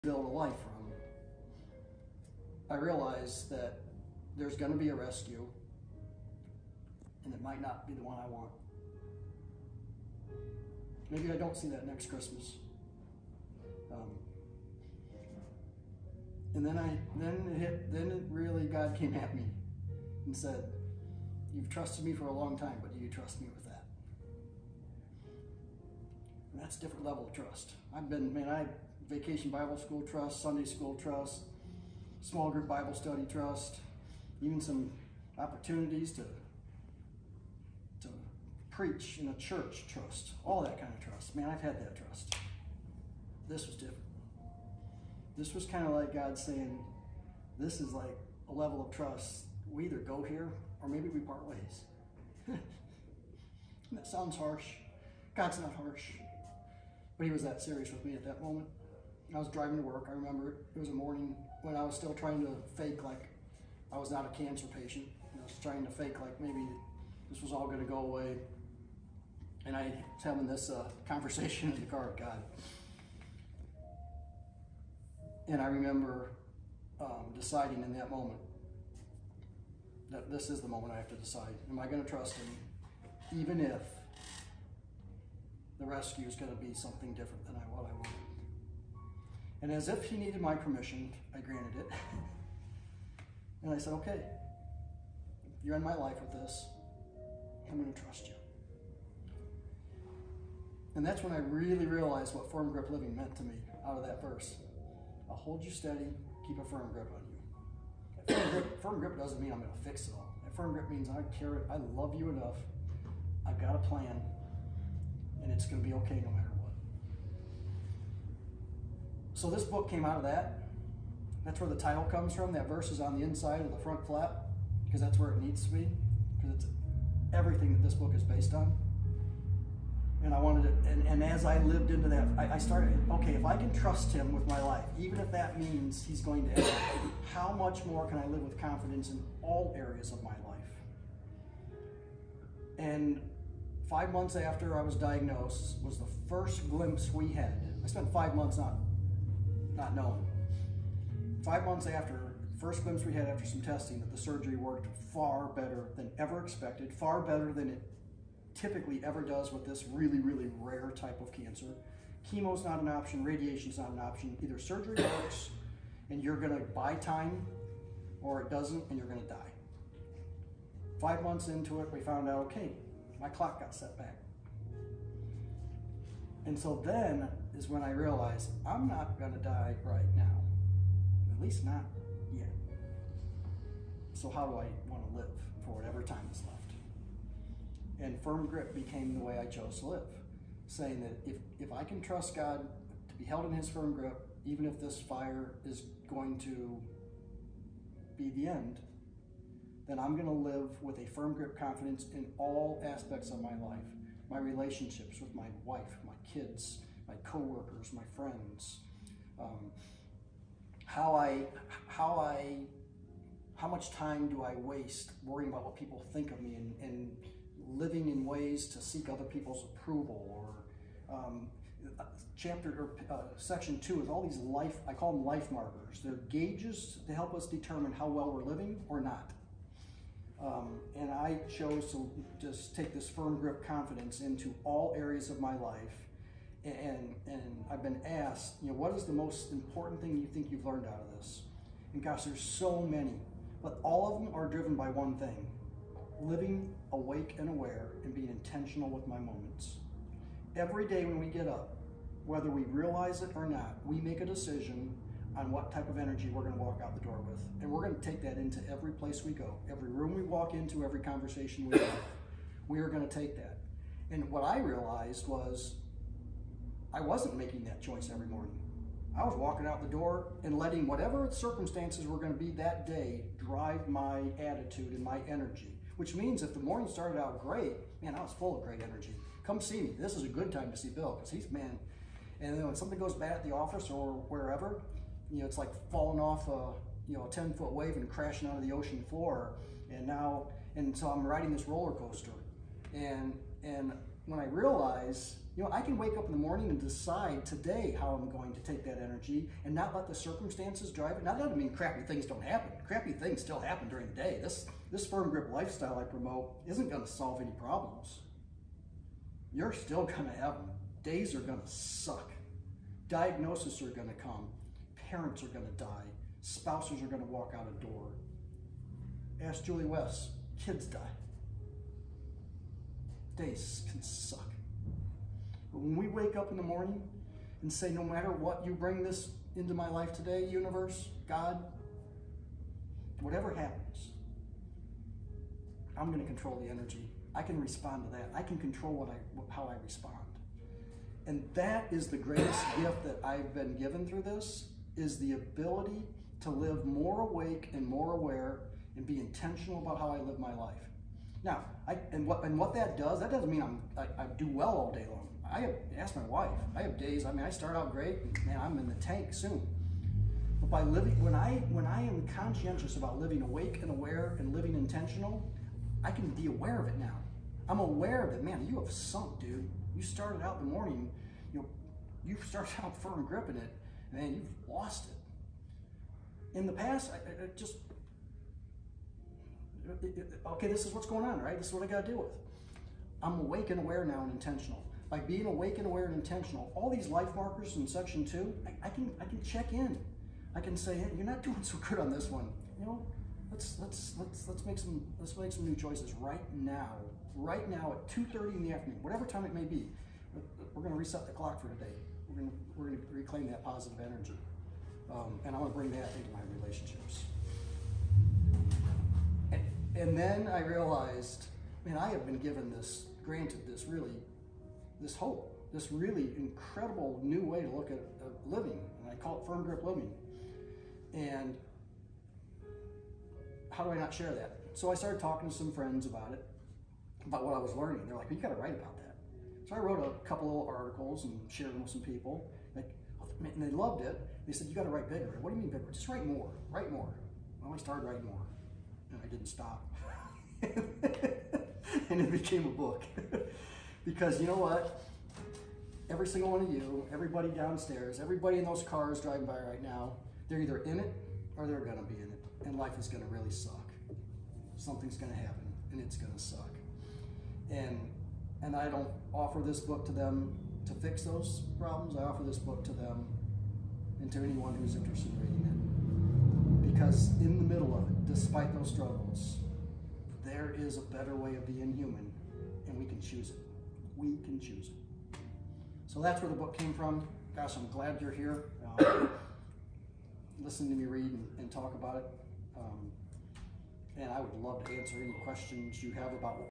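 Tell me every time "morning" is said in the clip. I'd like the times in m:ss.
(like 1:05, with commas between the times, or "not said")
1:00, 4:28, 4:36, 4:56, 5:26, 6:10.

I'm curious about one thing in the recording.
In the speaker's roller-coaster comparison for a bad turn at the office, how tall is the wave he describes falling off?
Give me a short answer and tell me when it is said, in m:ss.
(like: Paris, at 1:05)
10 foot, at 4:47.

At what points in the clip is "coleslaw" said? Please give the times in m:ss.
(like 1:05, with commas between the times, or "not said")
not said.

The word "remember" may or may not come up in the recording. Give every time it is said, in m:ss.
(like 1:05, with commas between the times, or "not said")
1:00, 1:15.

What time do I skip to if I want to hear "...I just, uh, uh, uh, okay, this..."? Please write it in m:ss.
6:17.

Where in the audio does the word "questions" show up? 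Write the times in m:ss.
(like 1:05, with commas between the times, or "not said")
8:05.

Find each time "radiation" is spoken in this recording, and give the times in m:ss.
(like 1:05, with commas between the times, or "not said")
2:43.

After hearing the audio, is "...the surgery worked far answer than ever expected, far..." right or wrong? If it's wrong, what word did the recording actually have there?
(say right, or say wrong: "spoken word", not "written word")
wrong: "better", not "answer".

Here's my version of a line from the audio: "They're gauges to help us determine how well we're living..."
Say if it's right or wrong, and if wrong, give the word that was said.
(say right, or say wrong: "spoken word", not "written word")
right.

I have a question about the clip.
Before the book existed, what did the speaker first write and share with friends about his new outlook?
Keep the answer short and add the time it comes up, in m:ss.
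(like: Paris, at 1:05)
A couple little articles, at 7:10.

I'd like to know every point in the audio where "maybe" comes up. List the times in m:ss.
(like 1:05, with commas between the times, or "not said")
0:11, 0:50, 1:06.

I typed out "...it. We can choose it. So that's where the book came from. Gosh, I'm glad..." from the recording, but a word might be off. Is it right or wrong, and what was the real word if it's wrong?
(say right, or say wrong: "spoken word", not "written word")
right.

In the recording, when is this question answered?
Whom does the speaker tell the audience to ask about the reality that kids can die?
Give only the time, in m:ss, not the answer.
5:19.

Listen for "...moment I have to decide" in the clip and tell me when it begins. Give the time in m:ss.
1:20.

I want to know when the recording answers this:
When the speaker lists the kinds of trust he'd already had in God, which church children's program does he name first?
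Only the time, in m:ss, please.
0:29.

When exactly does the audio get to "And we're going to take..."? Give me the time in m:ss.
4:17.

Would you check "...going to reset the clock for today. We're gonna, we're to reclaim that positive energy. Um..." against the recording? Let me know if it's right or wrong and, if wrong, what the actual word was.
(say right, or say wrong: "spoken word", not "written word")
right.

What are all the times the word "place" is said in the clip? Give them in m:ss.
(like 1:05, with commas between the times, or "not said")
4:18.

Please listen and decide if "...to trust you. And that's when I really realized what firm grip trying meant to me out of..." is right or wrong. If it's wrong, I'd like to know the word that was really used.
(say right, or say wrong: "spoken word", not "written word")
wrong: "living", not "trying".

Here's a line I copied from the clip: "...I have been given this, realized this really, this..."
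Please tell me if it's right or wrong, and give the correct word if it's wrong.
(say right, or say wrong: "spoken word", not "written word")
wrong: "granted", not "realized".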